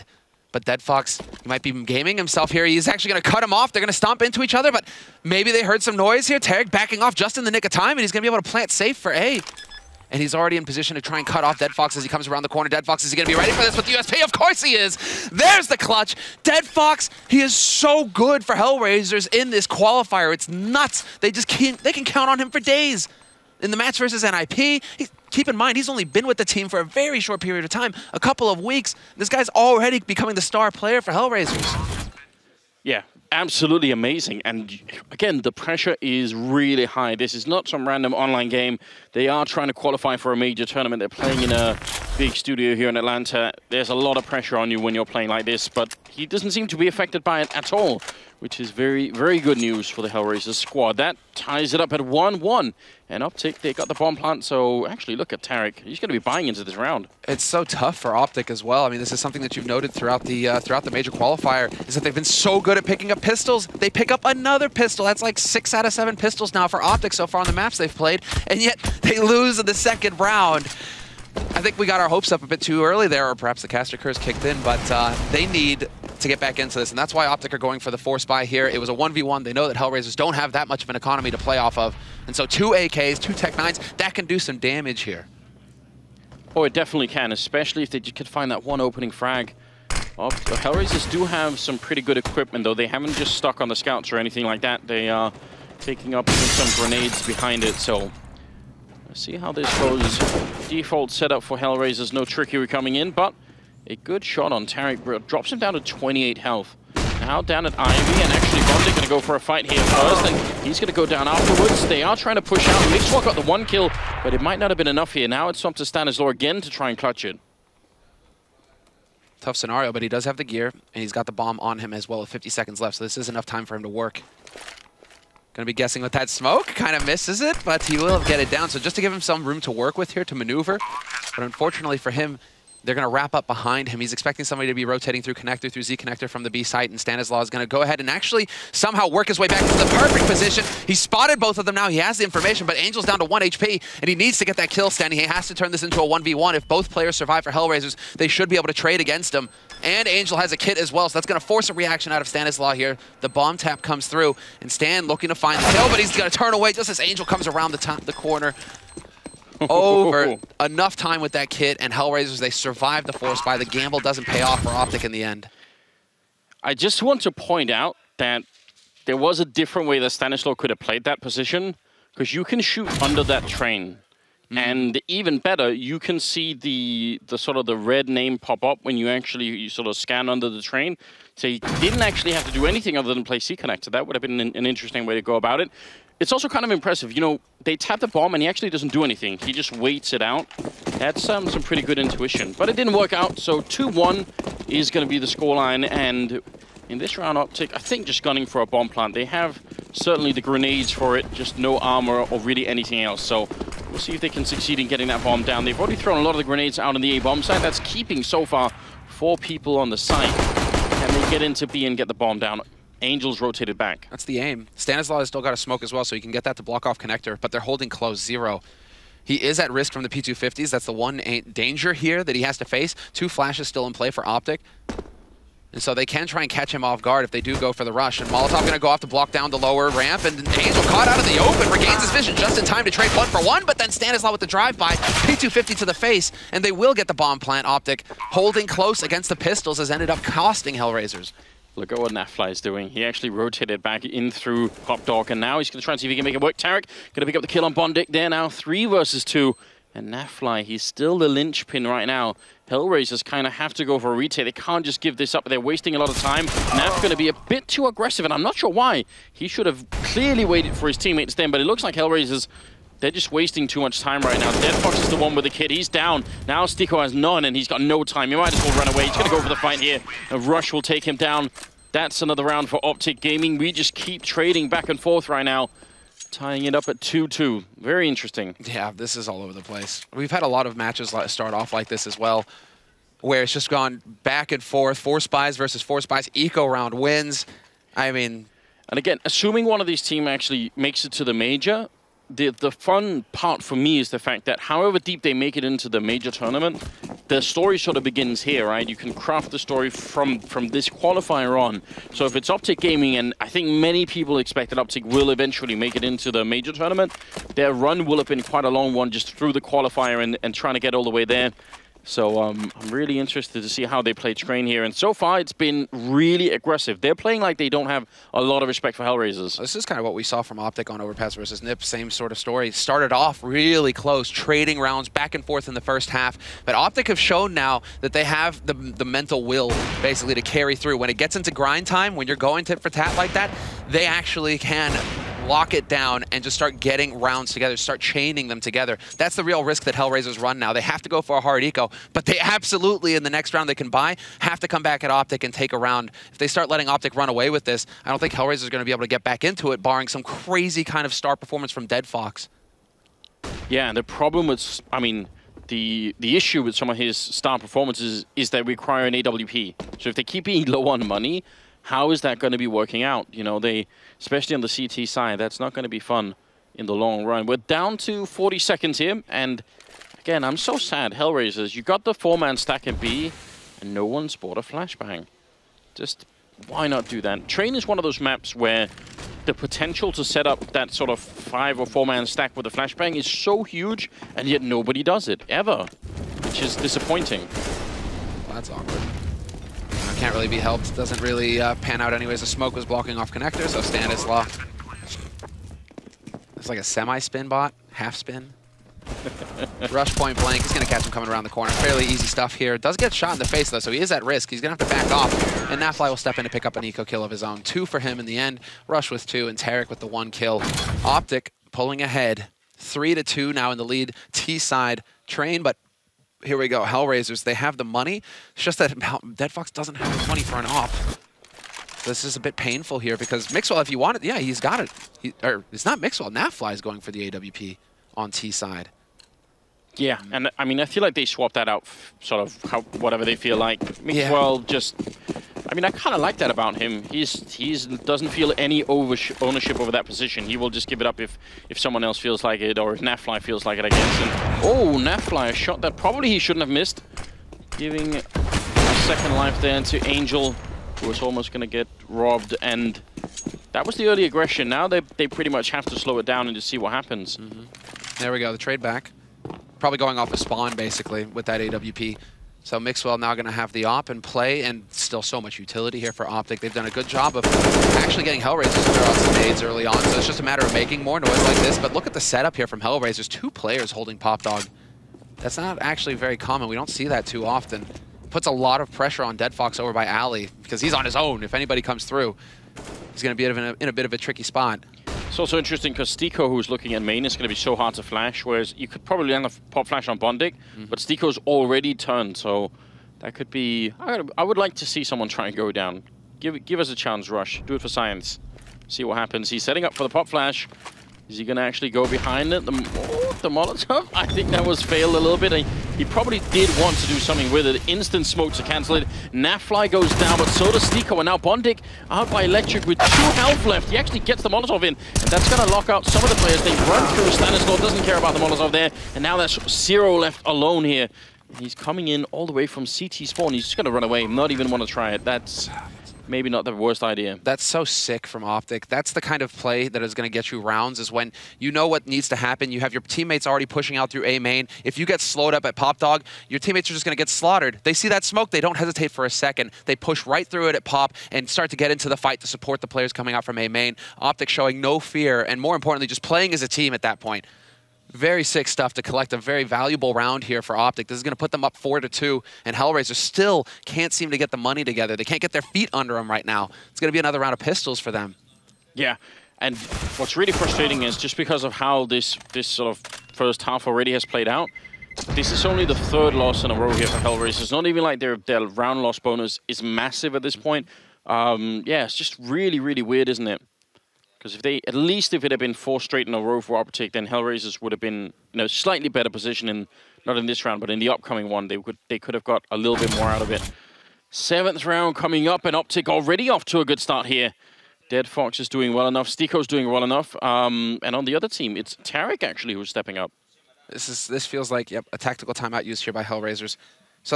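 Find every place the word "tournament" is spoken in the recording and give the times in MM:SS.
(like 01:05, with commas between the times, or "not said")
00:40, 04:56, 05:06.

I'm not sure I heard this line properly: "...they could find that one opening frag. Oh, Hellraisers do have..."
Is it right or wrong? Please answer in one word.
right.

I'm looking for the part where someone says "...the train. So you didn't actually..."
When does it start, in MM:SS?
03:00.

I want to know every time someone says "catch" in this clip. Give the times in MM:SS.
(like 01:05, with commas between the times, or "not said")
03:46, 06:40.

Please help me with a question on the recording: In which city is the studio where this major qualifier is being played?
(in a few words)
Atlanta.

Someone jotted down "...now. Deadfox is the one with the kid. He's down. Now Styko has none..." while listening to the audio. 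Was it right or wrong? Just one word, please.
right.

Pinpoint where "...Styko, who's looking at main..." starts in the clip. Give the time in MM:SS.
08:06.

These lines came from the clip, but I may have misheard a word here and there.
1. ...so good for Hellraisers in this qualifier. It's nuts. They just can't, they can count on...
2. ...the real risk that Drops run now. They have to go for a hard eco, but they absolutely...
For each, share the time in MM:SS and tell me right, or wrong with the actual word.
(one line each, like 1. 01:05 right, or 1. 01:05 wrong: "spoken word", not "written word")
1. 00:17 right
2. 05:39 wrong: "Hellraisers", not "Drops".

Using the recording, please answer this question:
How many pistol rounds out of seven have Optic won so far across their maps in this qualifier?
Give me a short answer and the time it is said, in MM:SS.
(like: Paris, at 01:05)
6, at 01:05.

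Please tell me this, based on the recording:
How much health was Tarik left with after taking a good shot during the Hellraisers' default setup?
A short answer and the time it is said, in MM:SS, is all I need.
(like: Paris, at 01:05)
28, at 01:45.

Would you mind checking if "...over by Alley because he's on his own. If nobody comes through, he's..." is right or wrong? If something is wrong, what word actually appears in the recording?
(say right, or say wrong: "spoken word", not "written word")
wrong: "anybody", not "nobody".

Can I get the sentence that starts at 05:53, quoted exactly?
Yeah, and the problem with, I mean, the the issue with some of his star performances is they require an AWP.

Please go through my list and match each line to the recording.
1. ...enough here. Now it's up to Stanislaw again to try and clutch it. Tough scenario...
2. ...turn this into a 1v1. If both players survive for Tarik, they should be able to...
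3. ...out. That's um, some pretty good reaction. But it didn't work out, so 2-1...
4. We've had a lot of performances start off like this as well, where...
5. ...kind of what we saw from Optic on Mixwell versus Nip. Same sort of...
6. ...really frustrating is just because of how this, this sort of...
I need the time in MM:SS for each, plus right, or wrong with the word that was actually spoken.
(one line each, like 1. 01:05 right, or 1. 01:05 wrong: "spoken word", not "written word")
1. 01:54 right
2. 02:25 wrong: "Hellraisers", not "Tarik"
3. 03:10 wrong: "intuition", not "reaction"
4. 04:40 wrong: "matches", not "performances"
5. 05:19 wrong: "Overpass", not "Mixwell"
6. 09:20 right.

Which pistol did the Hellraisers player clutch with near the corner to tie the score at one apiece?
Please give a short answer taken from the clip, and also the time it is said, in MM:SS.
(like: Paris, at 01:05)
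USP, at 00:13.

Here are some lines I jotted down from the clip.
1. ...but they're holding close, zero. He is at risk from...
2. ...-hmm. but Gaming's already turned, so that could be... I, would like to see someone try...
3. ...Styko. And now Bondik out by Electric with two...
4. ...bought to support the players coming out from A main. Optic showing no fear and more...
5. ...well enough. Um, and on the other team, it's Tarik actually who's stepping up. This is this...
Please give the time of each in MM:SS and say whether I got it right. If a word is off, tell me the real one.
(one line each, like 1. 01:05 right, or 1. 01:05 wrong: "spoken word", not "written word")
1. 03:37 right
2. 08:10 wrong: "Styko", not "Gaming"
3. 08:30 right
4. 09:02 wrong: "fight", not "bought"
5. 09:49 right.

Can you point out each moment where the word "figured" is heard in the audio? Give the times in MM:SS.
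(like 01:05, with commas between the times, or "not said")
not said.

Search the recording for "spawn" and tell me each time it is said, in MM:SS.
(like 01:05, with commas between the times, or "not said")
07:40, 08:43.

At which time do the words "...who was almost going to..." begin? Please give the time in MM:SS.
07:30.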